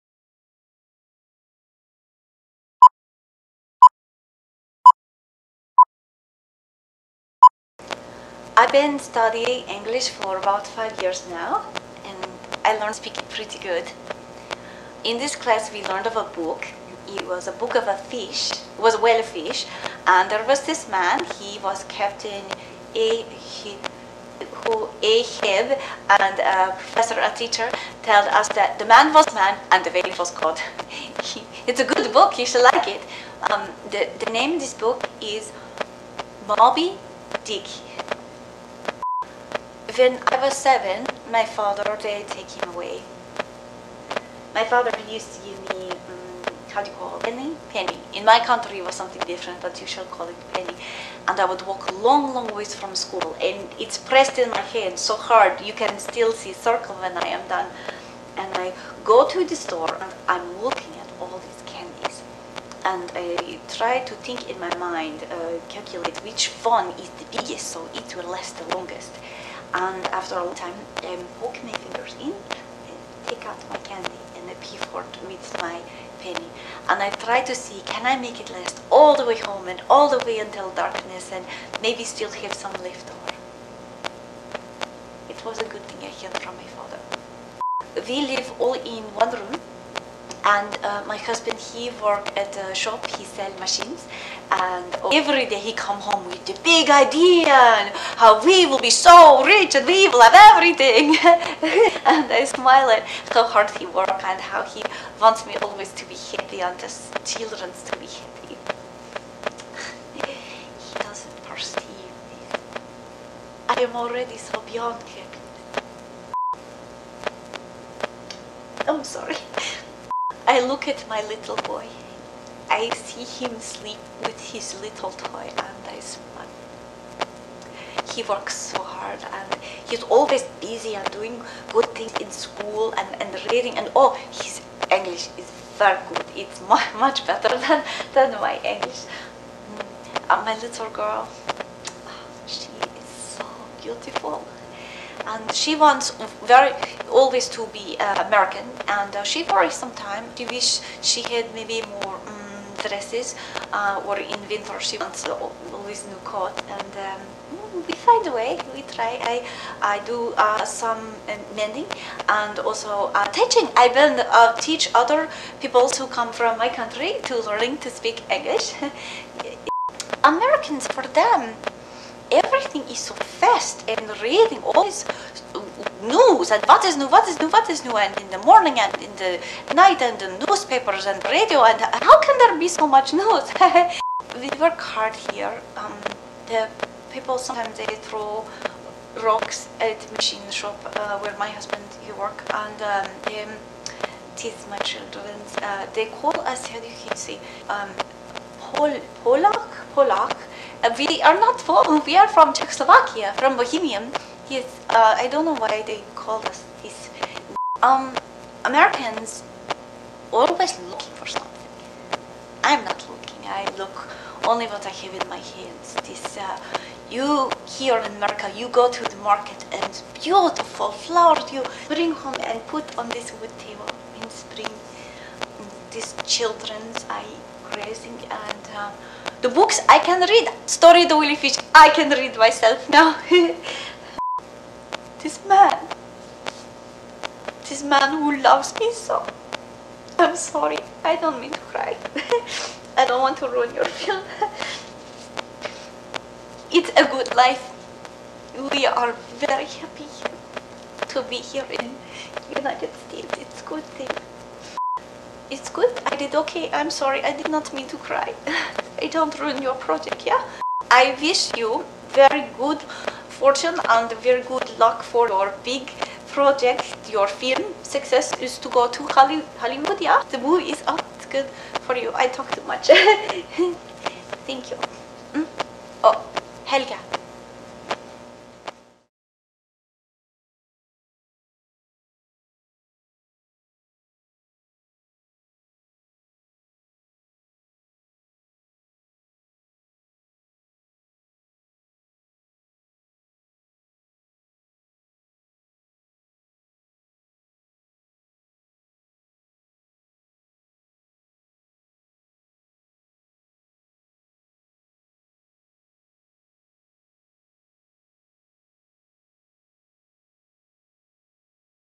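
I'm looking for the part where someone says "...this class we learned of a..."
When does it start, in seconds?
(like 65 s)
15 s.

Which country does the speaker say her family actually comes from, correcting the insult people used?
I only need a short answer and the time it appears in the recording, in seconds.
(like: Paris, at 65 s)
Czechoslovakia, at 202 s.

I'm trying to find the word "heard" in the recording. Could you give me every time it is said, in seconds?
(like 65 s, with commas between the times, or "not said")
86 s.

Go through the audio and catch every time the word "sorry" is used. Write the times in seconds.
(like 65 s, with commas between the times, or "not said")
119 s, 240 s, 256 s.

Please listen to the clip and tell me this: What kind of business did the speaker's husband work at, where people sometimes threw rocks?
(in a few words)
Machine shop.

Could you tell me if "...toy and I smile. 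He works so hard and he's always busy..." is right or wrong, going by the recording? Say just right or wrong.
right.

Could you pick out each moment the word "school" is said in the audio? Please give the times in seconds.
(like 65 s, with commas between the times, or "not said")
52 s, 132 s.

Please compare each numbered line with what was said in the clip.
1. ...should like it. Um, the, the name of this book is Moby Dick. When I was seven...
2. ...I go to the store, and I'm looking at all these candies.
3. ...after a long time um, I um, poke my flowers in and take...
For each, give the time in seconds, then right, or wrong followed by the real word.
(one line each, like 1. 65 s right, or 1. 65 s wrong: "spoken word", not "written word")
1. 32 s right
2. 58 s right
3. 70 s wrong: "fingers", not "flowers".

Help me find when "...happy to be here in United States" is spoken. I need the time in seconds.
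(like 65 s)
249 s.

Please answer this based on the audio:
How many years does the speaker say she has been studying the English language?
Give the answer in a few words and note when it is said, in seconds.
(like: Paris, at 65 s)
5, at 10 s.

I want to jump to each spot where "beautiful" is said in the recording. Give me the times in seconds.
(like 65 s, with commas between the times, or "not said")
143 s, 220 s.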